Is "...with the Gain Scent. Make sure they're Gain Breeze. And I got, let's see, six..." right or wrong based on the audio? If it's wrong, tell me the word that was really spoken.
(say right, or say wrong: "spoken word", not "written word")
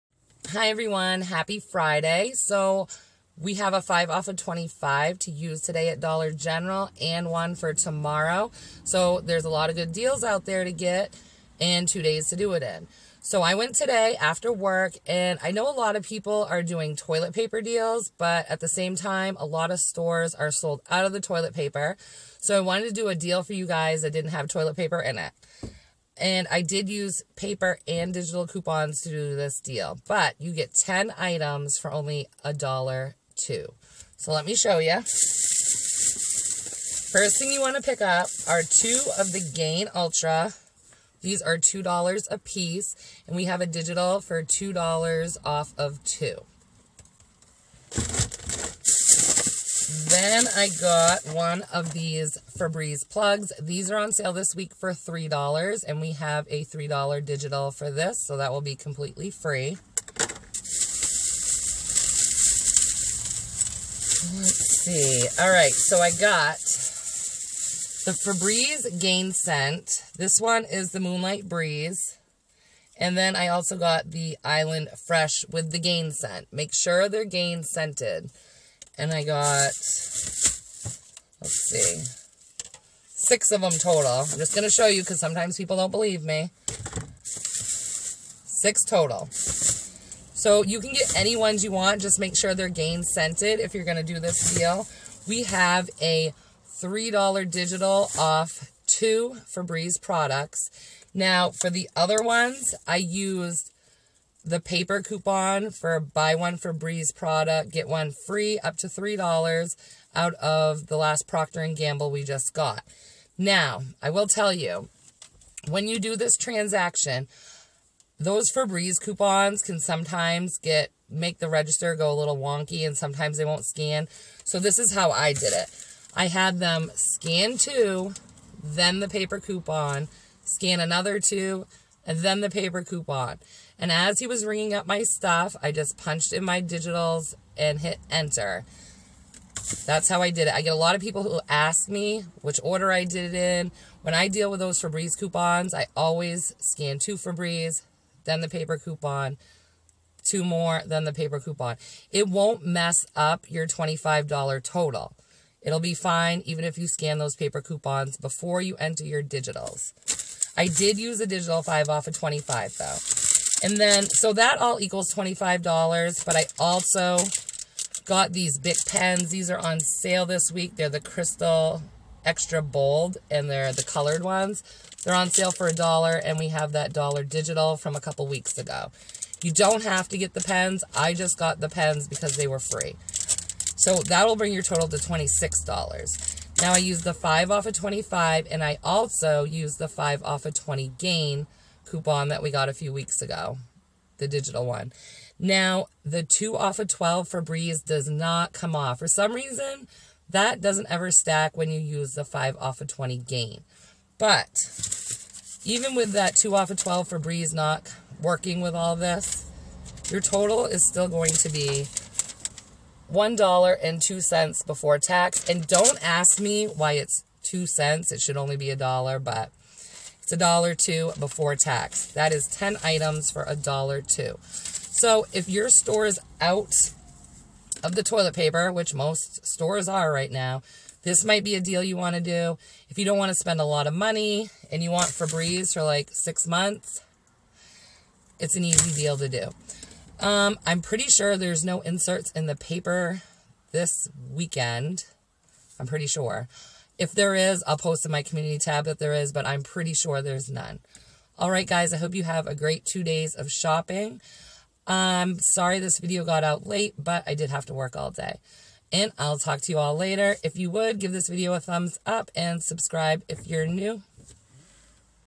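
wrong: "Scented", not "Breeze".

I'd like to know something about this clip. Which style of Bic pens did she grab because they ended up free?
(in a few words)
Crystal Extra Bold.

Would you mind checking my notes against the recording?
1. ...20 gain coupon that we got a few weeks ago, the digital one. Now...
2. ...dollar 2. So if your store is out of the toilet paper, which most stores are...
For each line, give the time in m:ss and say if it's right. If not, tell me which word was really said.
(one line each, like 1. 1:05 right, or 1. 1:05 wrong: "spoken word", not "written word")
1. 3:10 right
2. 3:43 right.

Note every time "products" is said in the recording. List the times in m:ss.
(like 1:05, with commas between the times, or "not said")
1:40, 1:47.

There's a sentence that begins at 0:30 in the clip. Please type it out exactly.
But you get 10 items for only a dollar two.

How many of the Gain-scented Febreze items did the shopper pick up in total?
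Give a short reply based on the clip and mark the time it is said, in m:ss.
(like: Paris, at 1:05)
6, at 1:27.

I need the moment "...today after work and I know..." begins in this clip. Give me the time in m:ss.
0:13.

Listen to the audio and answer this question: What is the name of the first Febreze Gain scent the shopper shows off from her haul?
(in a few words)
Moonlight Breeze.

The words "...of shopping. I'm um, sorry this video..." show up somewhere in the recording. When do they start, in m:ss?
4:13.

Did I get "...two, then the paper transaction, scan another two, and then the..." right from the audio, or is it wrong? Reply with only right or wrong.
wrong.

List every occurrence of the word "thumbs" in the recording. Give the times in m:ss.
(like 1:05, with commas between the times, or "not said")
4:21.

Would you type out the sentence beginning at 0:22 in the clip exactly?
So I wanted to do a deal for you guys that didn't have toilet paper in it.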